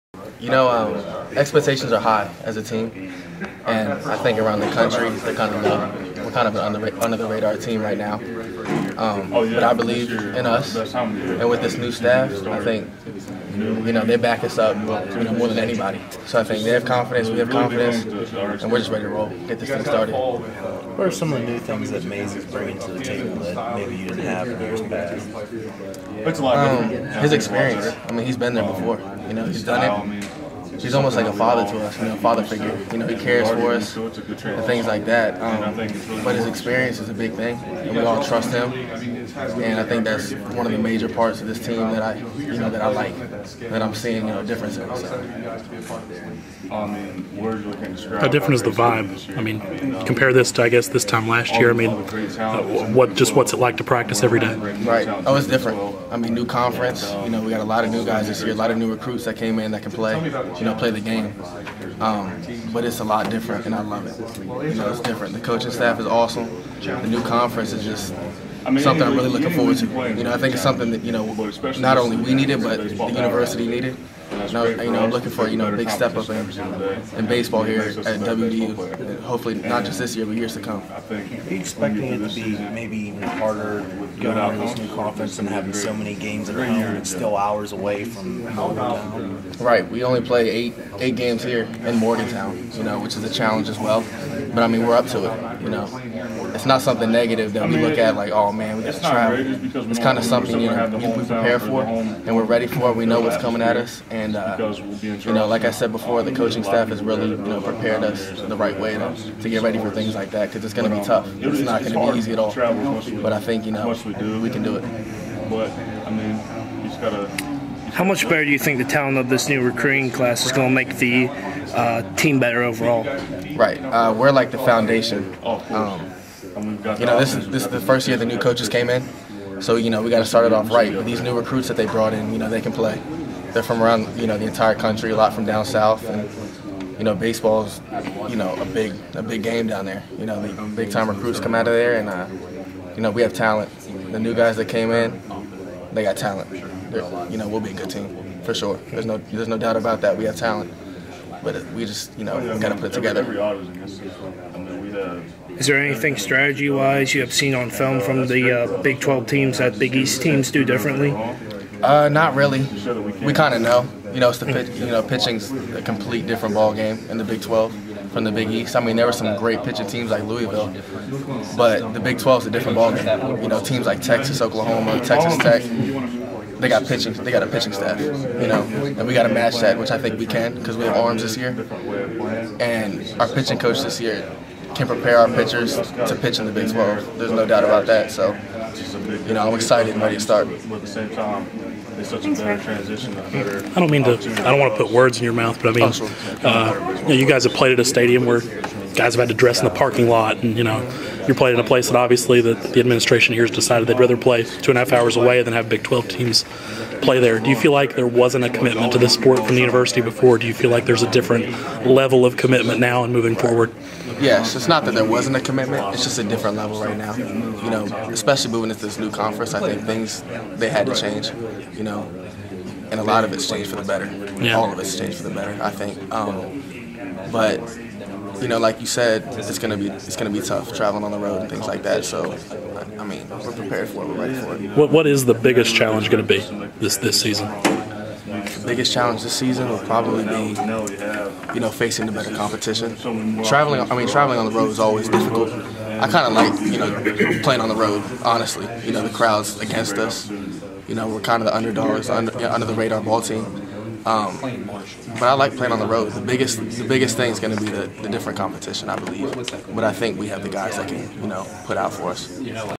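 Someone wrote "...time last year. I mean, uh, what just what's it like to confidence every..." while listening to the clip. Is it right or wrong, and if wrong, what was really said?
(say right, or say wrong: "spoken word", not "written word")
wrong: "practice", not "confidence".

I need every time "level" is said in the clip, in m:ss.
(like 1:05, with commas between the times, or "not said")
3:31, 3:36.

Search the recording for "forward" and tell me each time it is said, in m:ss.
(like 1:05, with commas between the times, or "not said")
1:09, 3:33.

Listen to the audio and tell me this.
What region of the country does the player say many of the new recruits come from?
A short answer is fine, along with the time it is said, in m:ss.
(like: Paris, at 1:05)
down south, at 2:15.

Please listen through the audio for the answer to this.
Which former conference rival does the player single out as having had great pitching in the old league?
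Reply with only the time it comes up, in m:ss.
2:50.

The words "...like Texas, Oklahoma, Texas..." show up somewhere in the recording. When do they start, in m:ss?
2:53.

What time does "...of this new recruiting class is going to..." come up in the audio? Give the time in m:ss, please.
1:59.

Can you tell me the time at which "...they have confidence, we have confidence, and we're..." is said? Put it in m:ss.
0:16.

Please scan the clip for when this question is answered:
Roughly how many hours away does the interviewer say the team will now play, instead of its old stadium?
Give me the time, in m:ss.
3:24.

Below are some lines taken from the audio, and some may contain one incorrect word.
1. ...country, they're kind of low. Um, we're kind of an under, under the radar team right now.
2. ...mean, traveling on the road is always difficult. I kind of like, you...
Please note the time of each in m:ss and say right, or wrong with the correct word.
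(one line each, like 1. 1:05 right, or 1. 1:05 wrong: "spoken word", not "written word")
1. 0:04 right
2. 4:03 right.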